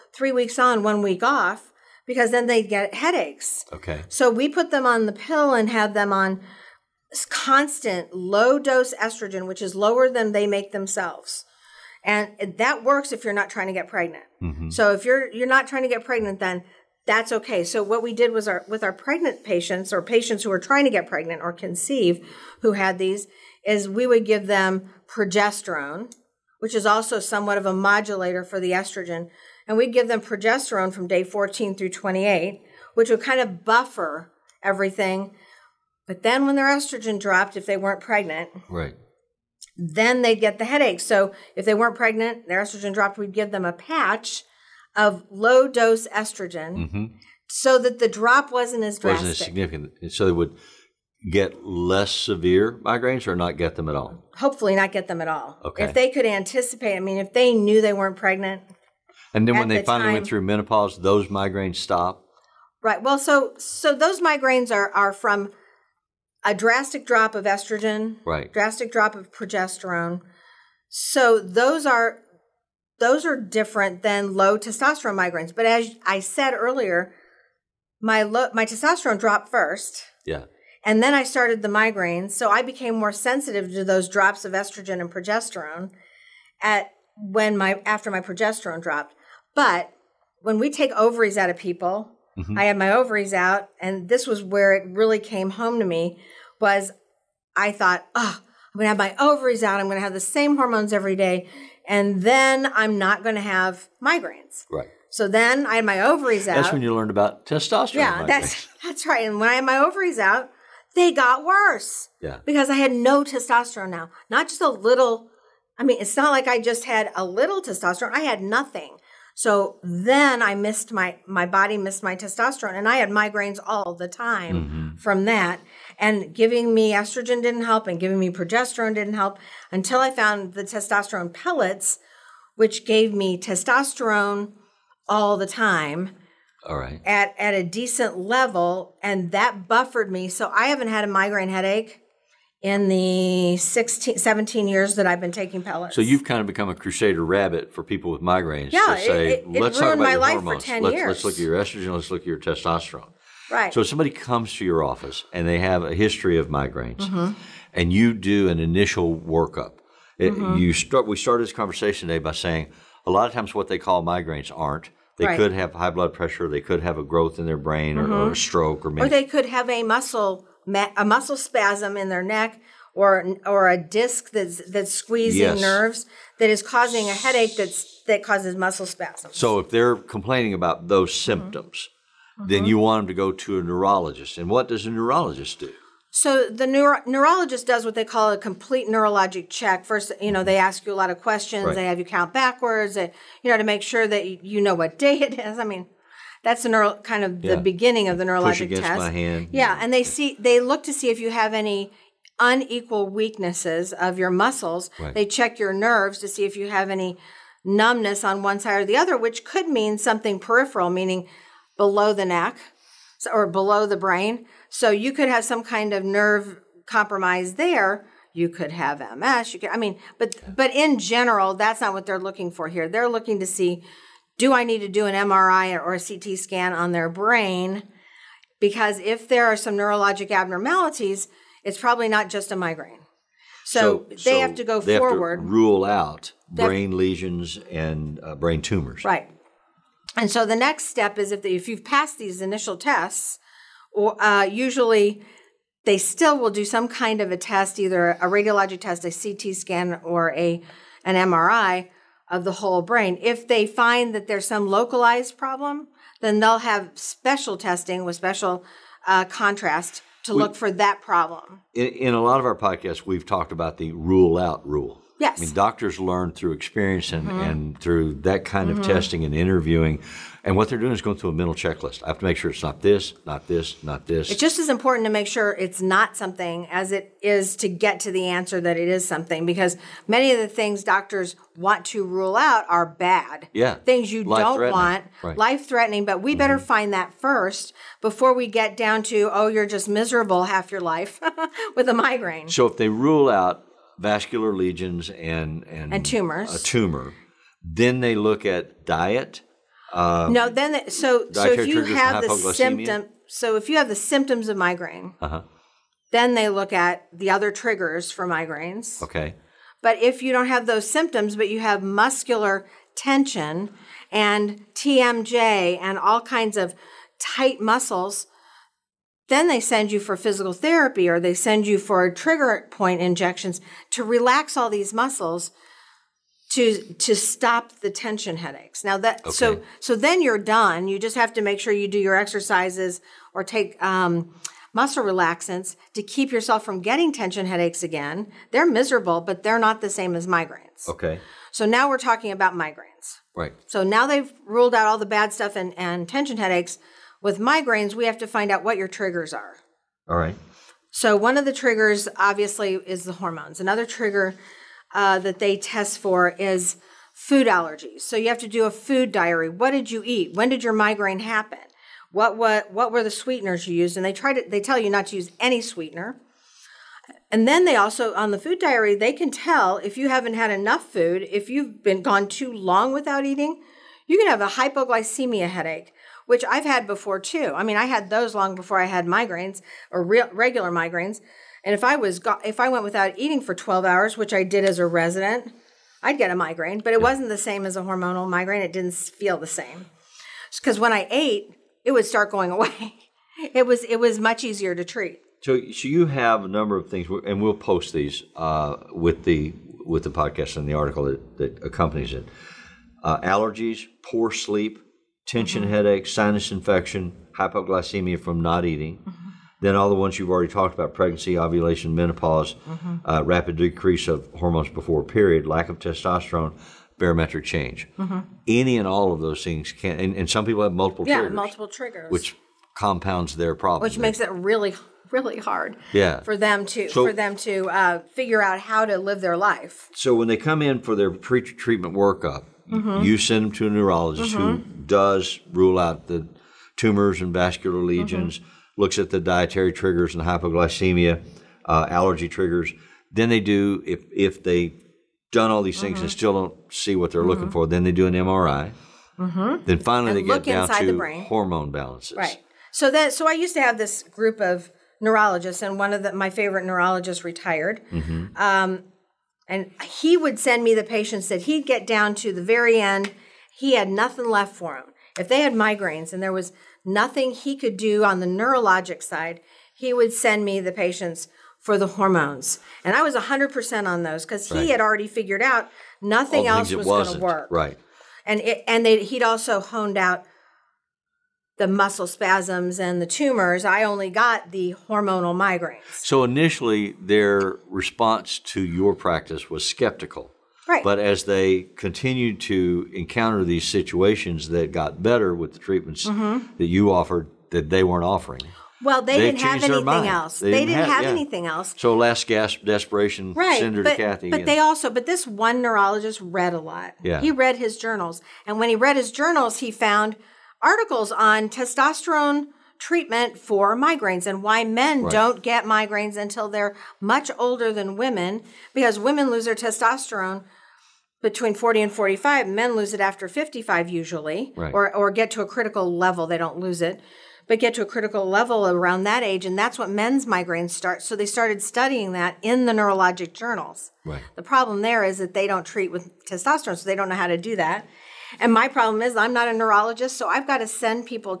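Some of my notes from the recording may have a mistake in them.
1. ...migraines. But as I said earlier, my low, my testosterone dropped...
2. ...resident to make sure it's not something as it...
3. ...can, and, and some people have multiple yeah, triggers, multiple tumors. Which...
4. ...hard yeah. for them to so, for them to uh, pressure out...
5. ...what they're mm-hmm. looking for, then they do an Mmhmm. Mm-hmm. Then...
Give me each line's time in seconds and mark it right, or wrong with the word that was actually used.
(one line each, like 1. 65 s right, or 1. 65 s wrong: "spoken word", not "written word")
1. 75 s right
2. 274 s wrong: "important", not "resident"
3. 419 s wrong: "triggers", not "tumors"
4. 425 s wrong: "figure", not "pressure"
5. 446 s wrong: "MRI", not "Mmhmm".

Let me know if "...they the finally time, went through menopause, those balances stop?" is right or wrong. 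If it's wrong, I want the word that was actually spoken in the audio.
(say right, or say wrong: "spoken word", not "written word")
wrong: "migraines", not "balances".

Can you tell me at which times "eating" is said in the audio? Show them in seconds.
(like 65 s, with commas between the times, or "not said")
373 s, 383 s, 408 s.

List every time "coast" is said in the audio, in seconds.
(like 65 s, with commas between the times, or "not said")
not said.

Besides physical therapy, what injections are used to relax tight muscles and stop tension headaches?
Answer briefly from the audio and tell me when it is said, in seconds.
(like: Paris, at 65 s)
Trigger point injections, at 322 s.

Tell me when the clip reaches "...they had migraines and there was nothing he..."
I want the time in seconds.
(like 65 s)
465 s.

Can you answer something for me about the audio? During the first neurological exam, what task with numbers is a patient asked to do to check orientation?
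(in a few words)
Count backwards.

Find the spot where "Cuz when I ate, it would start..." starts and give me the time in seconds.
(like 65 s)
390 s.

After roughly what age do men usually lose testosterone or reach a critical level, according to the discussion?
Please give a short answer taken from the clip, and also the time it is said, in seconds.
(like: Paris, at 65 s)
55, at 523 s.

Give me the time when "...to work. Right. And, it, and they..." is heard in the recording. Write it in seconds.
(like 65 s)
477 s.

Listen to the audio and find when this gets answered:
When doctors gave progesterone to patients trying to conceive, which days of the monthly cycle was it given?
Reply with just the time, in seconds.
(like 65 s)
31 s.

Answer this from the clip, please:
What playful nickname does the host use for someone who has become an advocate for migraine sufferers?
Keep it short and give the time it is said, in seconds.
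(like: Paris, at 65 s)
Crusader rabbit, at 146 s.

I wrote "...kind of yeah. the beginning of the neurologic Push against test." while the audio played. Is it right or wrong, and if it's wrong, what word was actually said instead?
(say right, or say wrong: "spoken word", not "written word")
right.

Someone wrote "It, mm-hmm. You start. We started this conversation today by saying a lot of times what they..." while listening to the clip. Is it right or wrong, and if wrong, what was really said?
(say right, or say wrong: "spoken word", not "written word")
right.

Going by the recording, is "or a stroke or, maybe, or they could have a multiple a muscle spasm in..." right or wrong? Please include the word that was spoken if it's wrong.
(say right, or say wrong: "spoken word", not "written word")
wrong: "muscle", not "multiple".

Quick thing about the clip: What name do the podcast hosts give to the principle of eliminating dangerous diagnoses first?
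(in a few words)
The rule out rule.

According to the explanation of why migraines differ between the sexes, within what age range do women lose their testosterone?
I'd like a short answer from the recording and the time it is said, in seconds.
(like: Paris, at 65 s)
40 to 45, at 521 s.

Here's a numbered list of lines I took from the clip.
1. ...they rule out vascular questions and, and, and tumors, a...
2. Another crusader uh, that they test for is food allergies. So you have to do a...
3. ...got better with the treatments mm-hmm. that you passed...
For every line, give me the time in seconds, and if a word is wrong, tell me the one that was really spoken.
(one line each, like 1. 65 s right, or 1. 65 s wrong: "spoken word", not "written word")
1. 292 s wrong: "lesions", not "questions"
2. 353 s wrong: "trigger", not "crusader"
3. 494 s wrong: "offered", not "passed".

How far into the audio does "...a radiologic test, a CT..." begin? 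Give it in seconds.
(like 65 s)
248 s.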